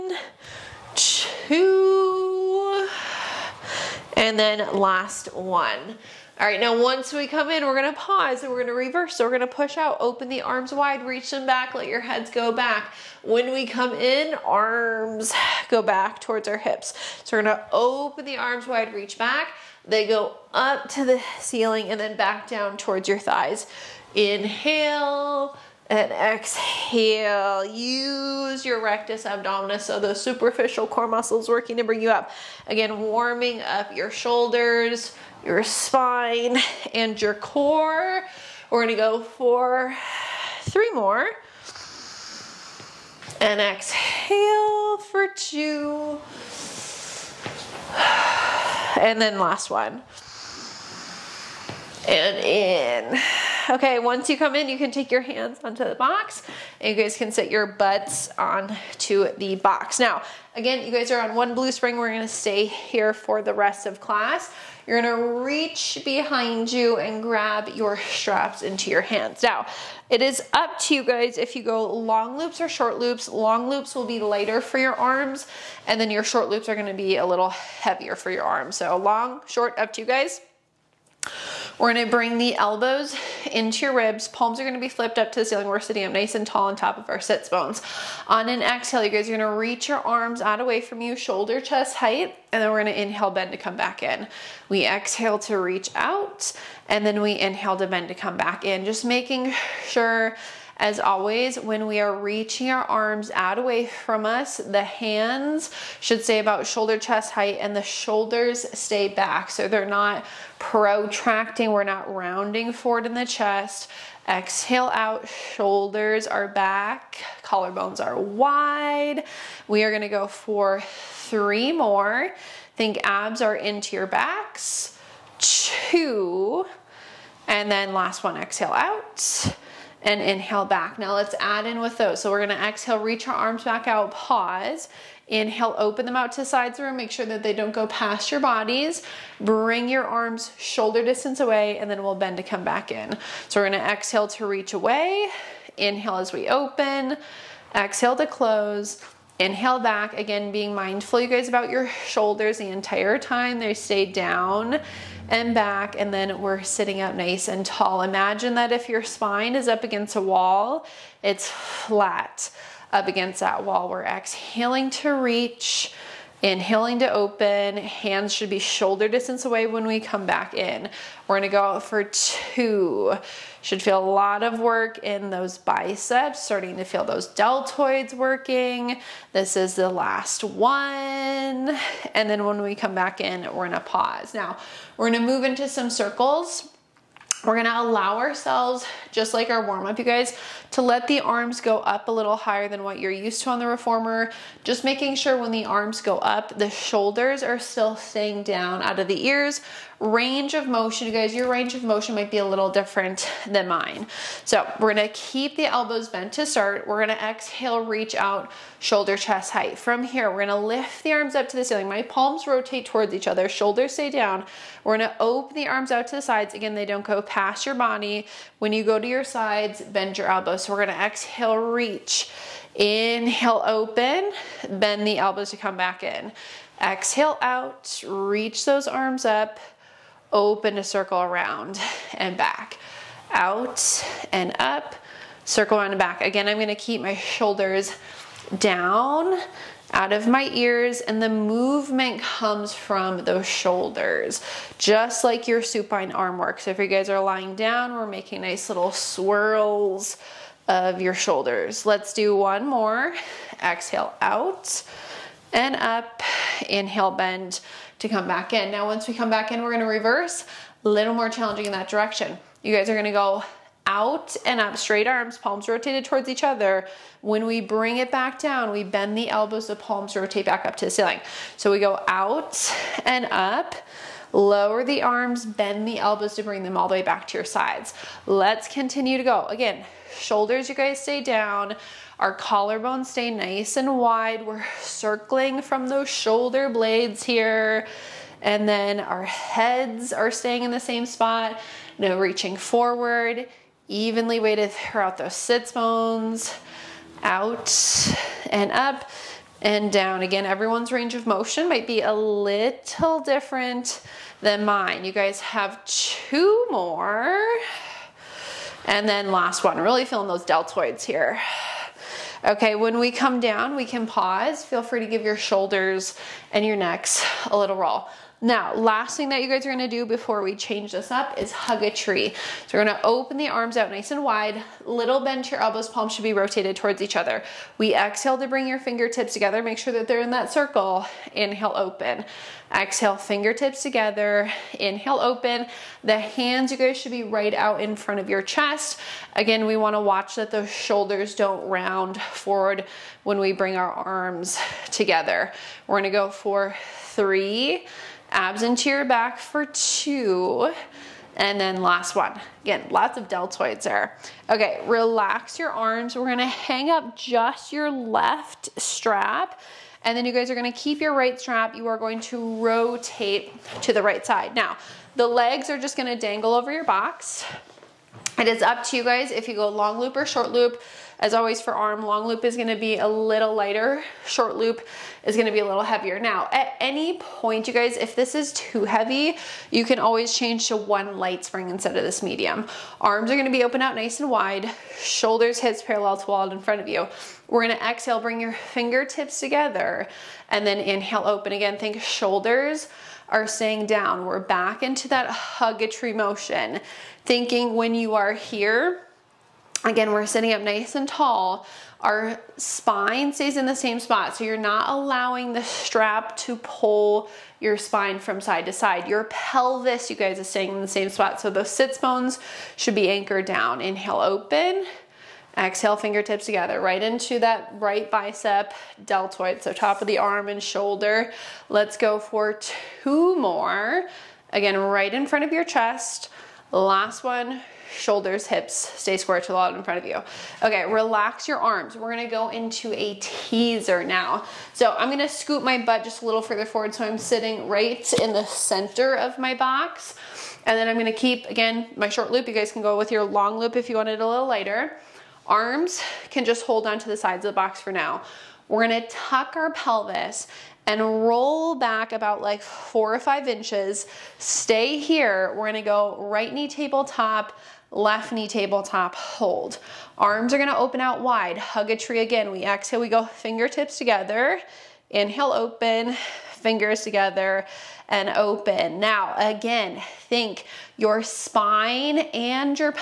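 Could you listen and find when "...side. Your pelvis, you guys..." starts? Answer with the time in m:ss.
6:48.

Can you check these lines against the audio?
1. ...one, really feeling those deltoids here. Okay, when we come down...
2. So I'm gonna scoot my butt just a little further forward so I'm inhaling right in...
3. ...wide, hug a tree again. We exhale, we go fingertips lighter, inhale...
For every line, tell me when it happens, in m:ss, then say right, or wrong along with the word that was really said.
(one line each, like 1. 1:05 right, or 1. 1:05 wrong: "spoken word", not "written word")
1. 5:09 right
2. 7:14 wrong: "sitting", not "inhaling"
3. 7:41 wrong: "together", not "lighter".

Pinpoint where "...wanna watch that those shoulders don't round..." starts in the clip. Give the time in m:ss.
5:39.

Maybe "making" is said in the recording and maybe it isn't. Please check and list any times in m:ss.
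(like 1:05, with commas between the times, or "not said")
1:39, 3:14, 4:08.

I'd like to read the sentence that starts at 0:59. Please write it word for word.
Now, again, you guys are on one blue spring.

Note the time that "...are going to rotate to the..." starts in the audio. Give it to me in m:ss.
6:01.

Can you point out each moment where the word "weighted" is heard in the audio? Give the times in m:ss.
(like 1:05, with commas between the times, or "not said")
4:54.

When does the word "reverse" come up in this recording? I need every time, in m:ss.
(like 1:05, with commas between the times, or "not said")
0:08, 4:19.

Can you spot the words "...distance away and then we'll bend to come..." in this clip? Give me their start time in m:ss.
2:21.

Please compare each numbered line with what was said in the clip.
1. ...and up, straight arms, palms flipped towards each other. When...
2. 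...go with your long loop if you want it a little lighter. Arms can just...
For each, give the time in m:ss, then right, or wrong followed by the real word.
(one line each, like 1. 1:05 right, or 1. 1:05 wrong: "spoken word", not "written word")
1. 4:24 wrong: "rotated", not "flipped"
2. 7:22 right.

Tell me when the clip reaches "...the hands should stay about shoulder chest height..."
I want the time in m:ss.
1:44.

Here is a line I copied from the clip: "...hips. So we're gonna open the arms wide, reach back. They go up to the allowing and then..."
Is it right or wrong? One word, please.
wrong.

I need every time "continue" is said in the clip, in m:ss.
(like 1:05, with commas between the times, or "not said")
4:38.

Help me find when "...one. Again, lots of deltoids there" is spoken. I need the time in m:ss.
5:52.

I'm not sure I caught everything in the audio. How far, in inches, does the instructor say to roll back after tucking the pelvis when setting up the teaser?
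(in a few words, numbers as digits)
4 or 5 inches.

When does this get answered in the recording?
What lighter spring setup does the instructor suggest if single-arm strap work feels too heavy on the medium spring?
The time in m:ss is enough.
6:20.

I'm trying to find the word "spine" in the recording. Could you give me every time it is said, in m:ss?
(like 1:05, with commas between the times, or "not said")
0:35, 2:39, 6:42, 6:47, 7:51.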